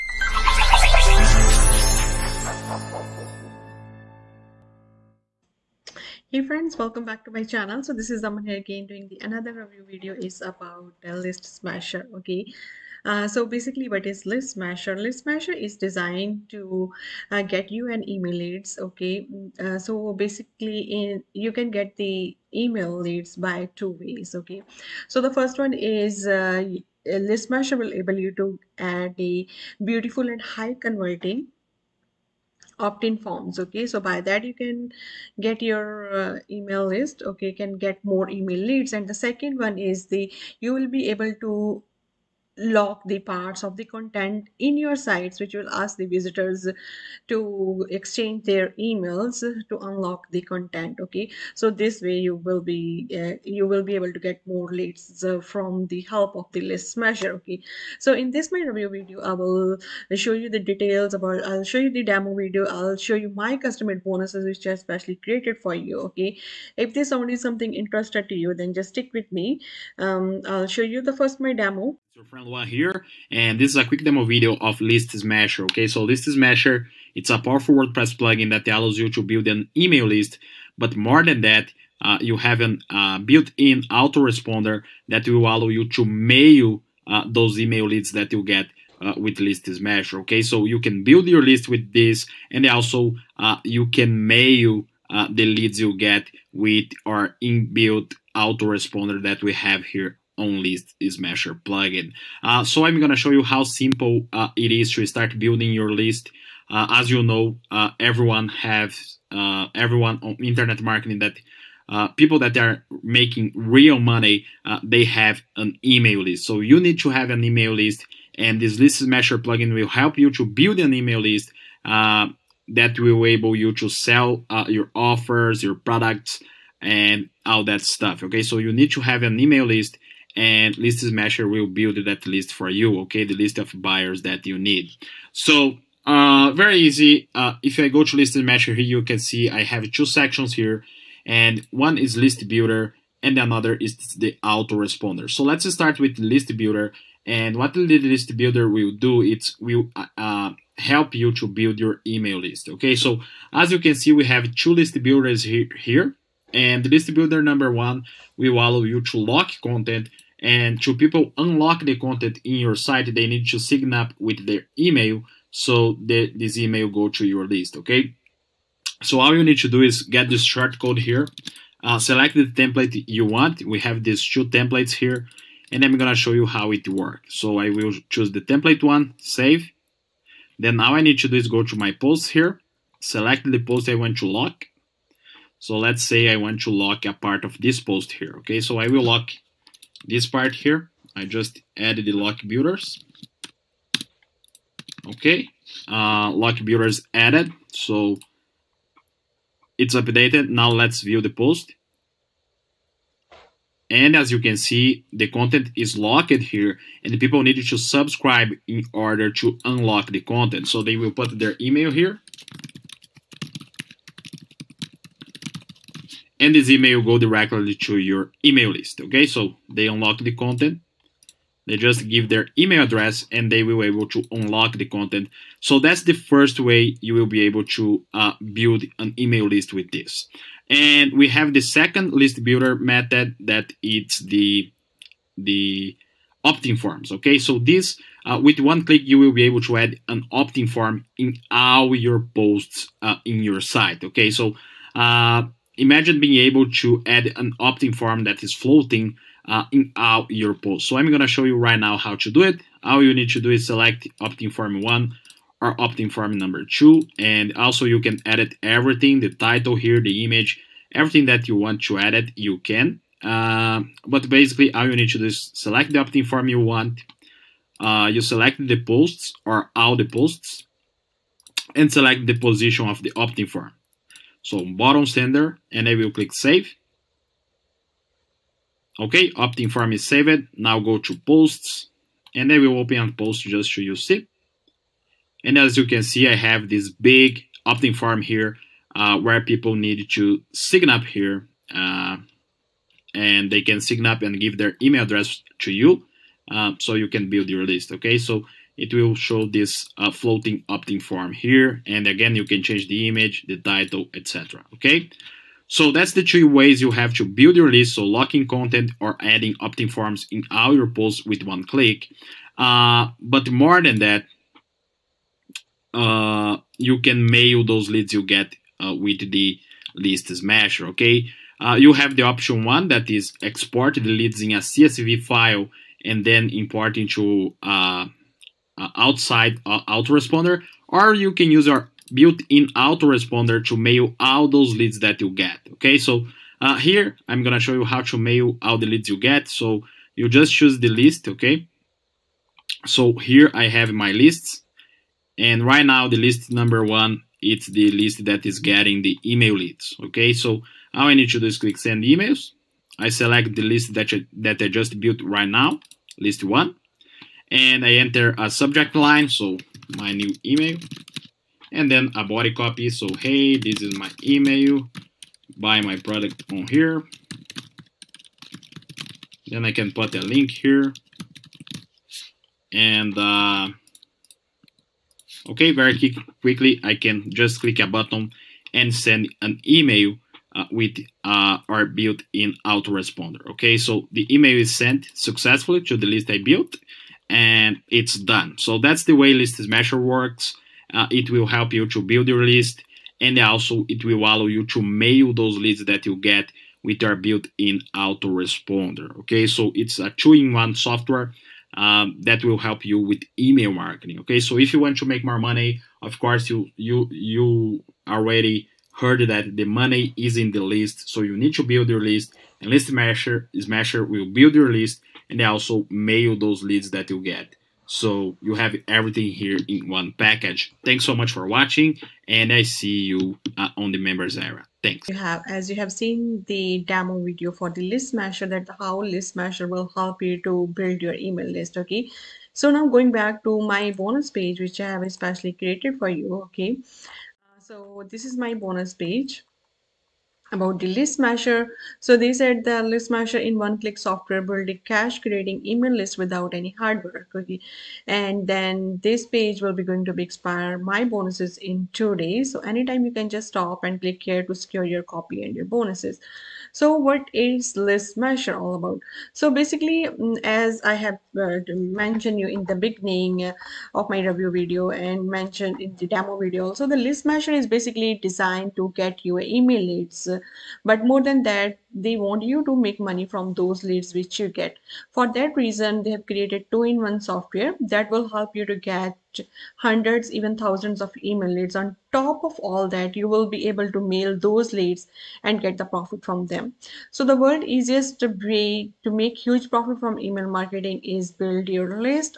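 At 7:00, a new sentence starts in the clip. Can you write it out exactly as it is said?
Thanks so much for watching and I see you uh, on the members area.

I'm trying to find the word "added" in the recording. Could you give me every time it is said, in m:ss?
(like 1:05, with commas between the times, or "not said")
3:11, 3:17.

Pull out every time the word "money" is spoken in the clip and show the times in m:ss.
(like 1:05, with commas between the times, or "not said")
1:53, 6:45, 6:49, 7:52.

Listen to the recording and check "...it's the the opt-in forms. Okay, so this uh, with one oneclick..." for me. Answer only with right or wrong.
wrong.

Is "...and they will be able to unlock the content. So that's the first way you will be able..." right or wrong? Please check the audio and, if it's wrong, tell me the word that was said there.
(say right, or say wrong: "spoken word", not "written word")
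right.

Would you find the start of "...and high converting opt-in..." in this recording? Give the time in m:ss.
0:30.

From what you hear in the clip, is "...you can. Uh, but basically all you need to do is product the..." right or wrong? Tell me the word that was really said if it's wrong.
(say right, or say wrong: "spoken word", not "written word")
wrong: "select", not "product".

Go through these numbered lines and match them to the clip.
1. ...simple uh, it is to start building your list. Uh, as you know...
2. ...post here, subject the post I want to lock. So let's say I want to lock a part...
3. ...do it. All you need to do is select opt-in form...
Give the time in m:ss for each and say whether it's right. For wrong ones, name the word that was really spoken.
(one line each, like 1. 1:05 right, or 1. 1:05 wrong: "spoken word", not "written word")
1. 1:43 right
2. 3:01 wrong: "select", not "subject"
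3. 4:12 right.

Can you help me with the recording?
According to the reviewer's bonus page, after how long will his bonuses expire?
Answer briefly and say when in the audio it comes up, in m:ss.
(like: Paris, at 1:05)
two days, at 7:31.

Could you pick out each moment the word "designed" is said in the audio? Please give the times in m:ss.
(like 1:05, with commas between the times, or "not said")
0:15, 7:48.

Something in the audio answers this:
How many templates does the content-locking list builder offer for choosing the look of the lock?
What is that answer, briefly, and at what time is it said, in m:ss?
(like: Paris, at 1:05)
2, at 2:54.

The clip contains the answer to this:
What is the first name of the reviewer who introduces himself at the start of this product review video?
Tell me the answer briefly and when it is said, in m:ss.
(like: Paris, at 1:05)
Aman, at 0:08.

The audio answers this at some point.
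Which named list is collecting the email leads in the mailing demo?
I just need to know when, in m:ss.
5:56.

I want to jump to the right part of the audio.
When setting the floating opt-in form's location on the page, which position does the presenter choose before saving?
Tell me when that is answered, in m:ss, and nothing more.
4:34.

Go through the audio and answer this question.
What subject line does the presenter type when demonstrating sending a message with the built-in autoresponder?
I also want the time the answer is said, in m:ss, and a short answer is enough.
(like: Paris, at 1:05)
my new email, at 5:59.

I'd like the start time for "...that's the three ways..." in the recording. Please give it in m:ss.
5:05.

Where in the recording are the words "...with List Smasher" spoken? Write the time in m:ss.
1:29.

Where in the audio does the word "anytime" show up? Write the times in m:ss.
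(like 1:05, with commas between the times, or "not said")
7:32.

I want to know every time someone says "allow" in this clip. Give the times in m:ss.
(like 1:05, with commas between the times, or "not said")
1:18, 1:25, 2:38, 6:34.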